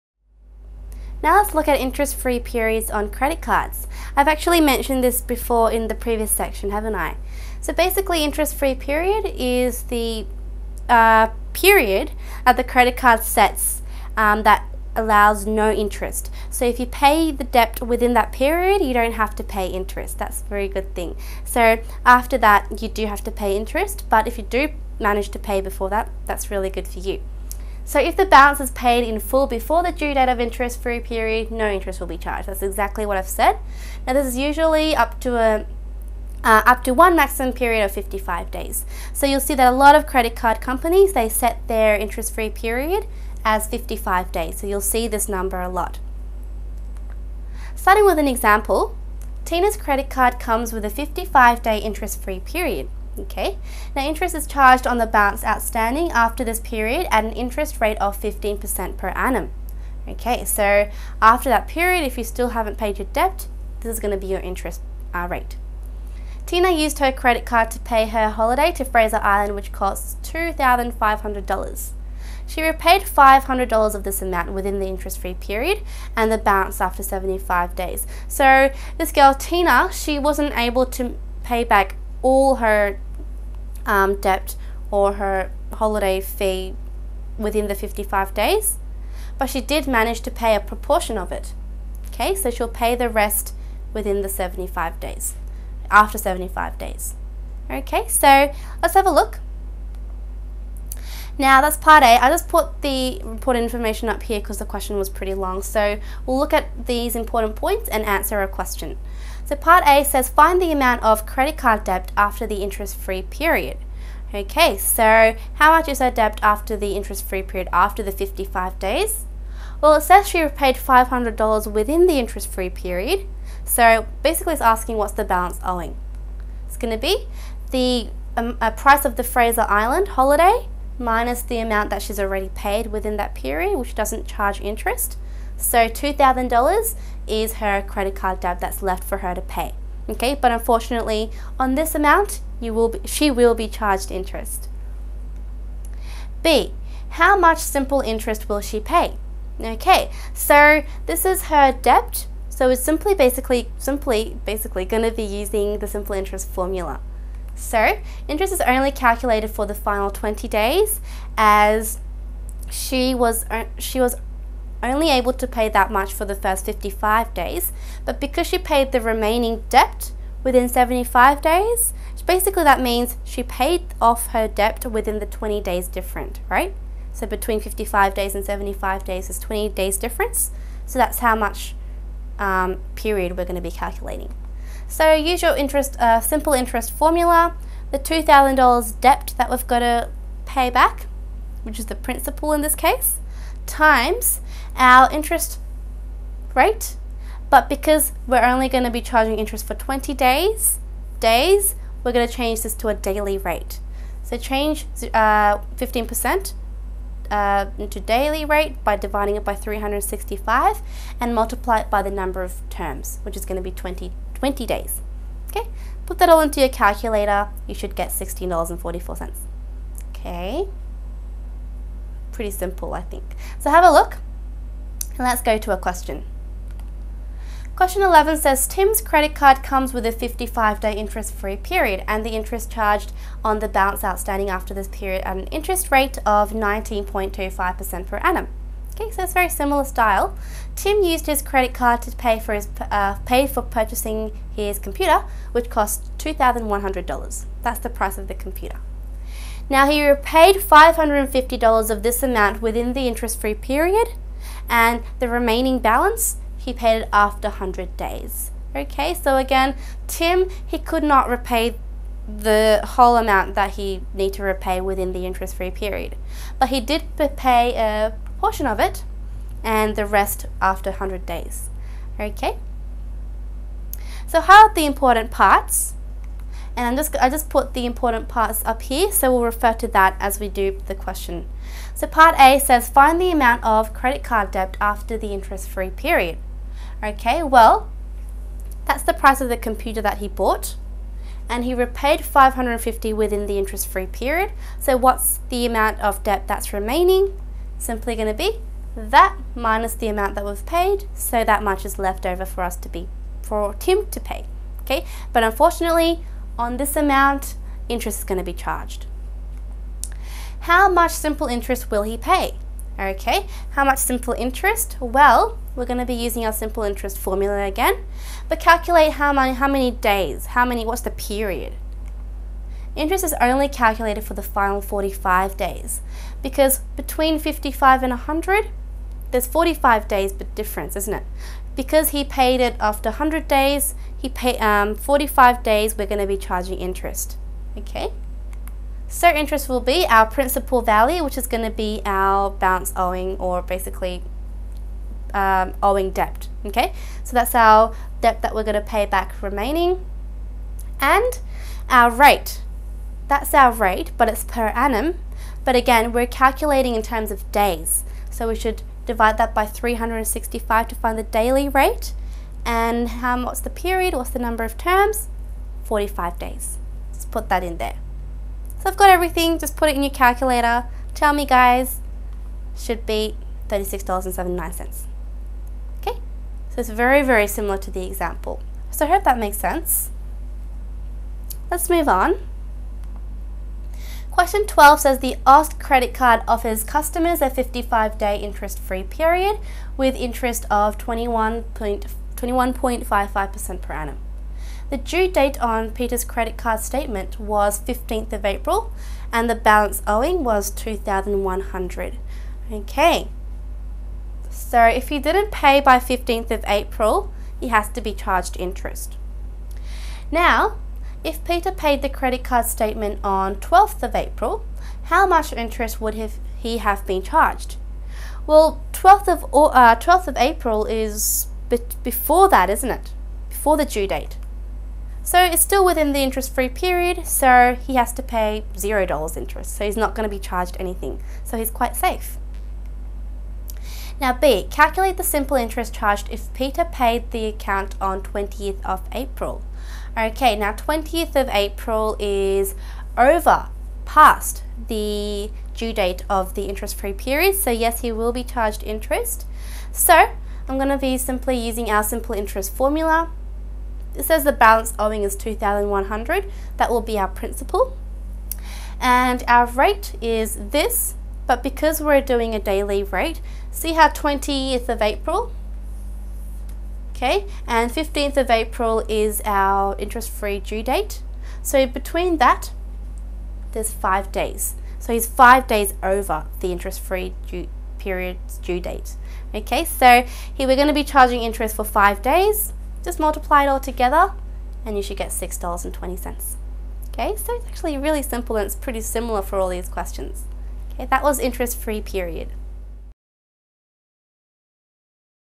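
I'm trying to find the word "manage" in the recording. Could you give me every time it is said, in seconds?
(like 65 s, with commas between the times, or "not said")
24 s, 89 s.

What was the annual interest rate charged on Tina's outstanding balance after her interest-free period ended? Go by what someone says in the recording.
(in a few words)
15%.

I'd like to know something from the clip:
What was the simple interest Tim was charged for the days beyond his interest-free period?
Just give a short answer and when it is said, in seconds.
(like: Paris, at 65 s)
$36.79, at 373 s.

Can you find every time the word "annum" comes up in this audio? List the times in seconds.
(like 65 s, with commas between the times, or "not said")
59 s, 238 s, 354 s, 393 s.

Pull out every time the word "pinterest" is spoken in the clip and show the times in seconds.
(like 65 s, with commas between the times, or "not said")
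not said.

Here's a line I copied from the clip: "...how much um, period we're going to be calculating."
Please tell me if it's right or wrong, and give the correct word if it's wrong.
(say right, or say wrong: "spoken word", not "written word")
right.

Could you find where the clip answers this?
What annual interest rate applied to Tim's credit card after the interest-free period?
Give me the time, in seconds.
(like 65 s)
236 s.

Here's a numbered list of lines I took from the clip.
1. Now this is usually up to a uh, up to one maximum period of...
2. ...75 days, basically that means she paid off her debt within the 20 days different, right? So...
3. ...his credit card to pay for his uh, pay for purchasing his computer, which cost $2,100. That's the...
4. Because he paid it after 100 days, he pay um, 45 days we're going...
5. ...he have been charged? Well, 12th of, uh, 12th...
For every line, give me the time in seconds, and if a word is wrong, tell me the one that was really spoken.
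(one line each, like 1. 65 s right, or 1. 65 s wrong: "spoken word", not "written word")
1. 34 s right
2. 170 s right
3. 241 s right
4. 331 s right
5. 416 s right.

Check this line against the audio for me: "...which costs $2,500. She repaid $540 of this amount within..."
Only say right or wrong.
wrong.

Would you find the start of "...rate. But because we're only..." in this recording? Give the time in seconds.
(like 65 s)
196 s.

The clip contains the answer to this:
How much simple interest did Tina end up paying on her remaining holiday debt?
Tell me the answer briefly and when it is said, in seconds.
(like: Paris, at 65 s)
$16.44, at 218 s.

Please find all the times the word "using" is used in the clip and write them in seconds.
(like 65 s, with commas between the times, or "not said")
155 s, 316 s, 451 s.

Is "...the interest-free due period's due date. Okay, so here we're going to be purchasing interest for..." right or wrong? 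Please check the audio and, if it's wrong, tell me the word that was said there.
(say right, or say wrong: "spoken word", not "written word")
wrong: "charging", not "purchasing".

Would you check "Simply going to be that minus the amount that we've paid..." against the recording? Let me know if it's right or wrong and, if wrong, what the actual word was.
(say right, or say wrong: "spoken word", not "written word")
right.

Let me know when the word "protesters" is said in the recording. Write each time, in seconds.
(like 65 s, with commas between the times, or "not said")
not said.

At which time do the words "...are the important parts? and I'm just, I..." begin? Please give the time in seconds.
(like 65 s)
274 s.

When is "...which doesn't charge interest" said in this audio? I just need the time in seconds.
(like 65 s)
133 s.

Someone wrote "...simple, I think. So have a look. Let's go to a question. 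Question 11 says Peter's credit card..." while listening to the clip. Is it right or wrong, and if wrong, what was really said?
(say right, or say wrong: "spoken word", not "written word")
wrong: "Tim", not "Peter".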